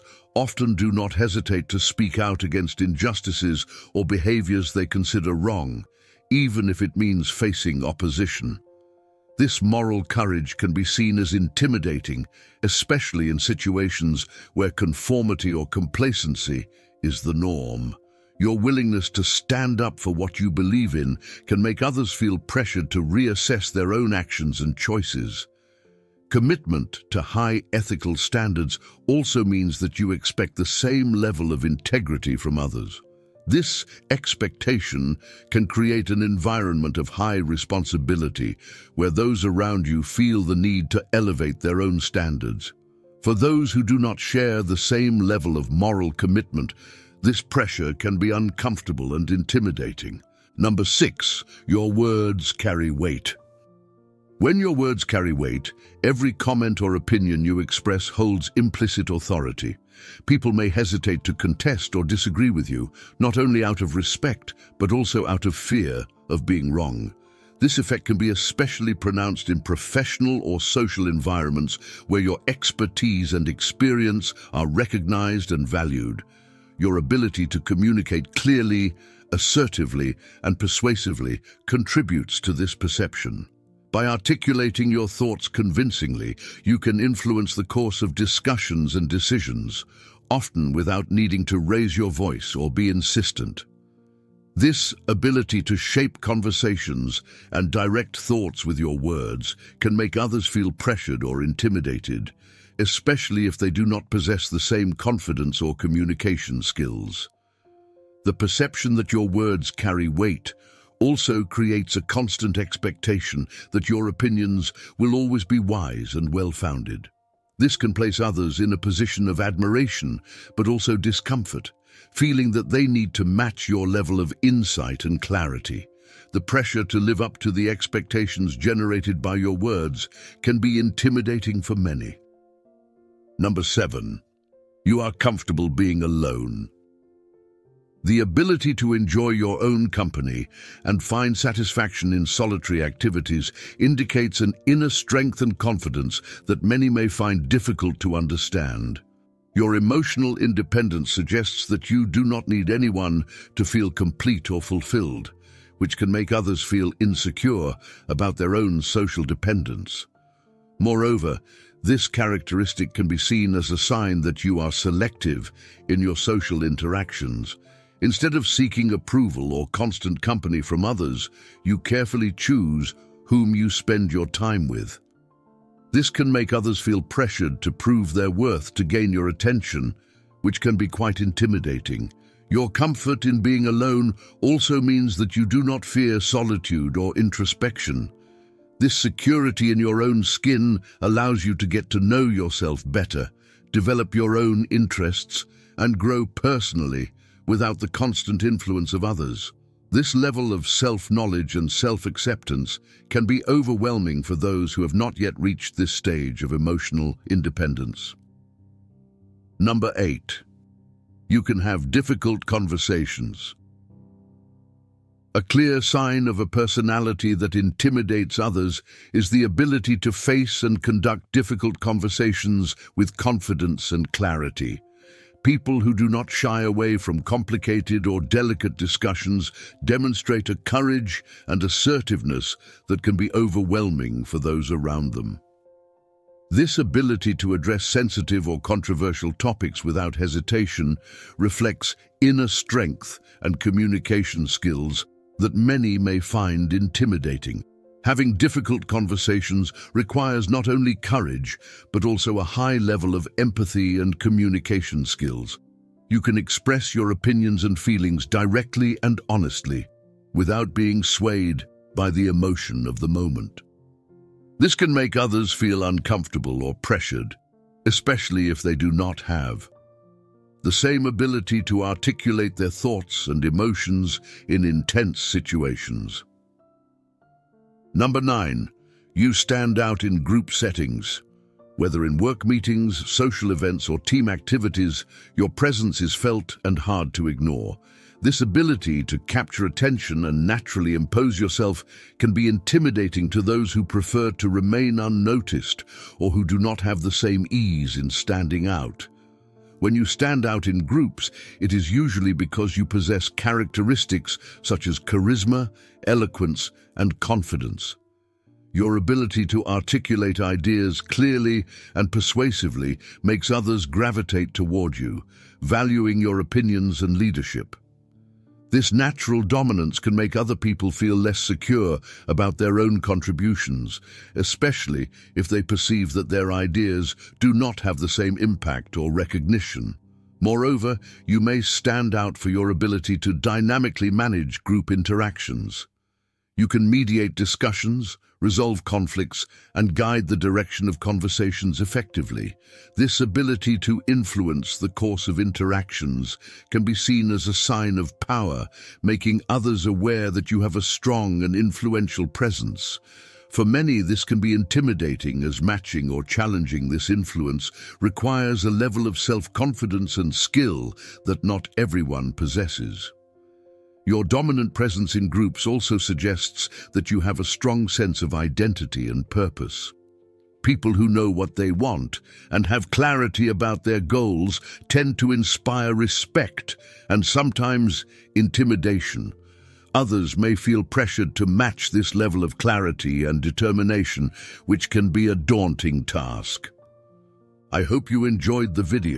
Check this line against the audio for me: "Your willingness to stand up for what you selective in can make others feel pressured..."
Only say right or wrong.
wrong.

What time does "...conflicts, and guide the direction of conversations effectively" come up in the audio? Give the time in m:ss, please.
5:38.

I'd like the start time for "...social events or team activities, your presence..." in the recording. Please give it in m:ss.
4:43.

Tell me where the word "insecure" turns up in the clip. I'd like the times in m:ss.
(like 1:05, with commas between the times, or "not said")
2:37.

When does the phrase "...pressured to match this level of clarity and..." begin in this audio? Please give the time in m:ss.
6:20.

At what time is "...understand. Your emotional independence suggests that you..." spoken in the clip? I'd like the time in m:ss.
2:28.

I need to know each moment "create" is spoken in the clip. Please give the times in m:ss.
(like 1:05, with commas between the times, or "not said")
0:35, 1:51.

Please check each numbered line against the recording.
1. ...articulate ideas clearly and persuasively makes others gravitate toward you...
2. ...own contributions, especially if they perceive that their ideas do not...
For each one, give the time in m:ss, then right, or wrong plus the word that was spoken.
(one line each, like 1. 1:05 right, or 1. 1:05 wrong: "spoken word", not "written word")
1. 5:09 right
2. 5:22 right.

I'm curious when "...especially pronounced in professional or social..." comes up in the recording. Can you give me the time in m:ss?
1:08.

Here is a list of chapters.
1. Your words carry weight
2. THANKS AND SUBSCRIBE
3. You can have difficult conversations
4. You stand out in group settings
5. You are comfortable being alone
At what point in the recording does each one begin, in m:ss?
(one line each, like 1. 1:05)
1. 0:50
2. 5:03
3. 3:29
4. 4:37
5. 2:13.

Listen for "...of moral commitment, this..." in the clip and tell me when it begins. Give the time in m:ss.
0:45.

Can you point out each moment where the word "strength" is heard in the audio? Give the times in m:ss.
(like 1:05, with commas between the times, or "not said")
2:24, 4:02.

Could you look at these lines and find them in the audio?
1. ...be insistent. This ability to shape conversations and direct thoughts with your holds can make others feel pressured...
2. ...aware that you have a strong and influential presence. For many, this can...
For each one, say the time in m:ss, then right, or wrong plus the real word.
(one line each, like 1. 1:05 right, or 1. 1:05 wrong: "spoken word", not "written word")
1. 1:32 wrong: "words", not "holds"
2. 5:49 right.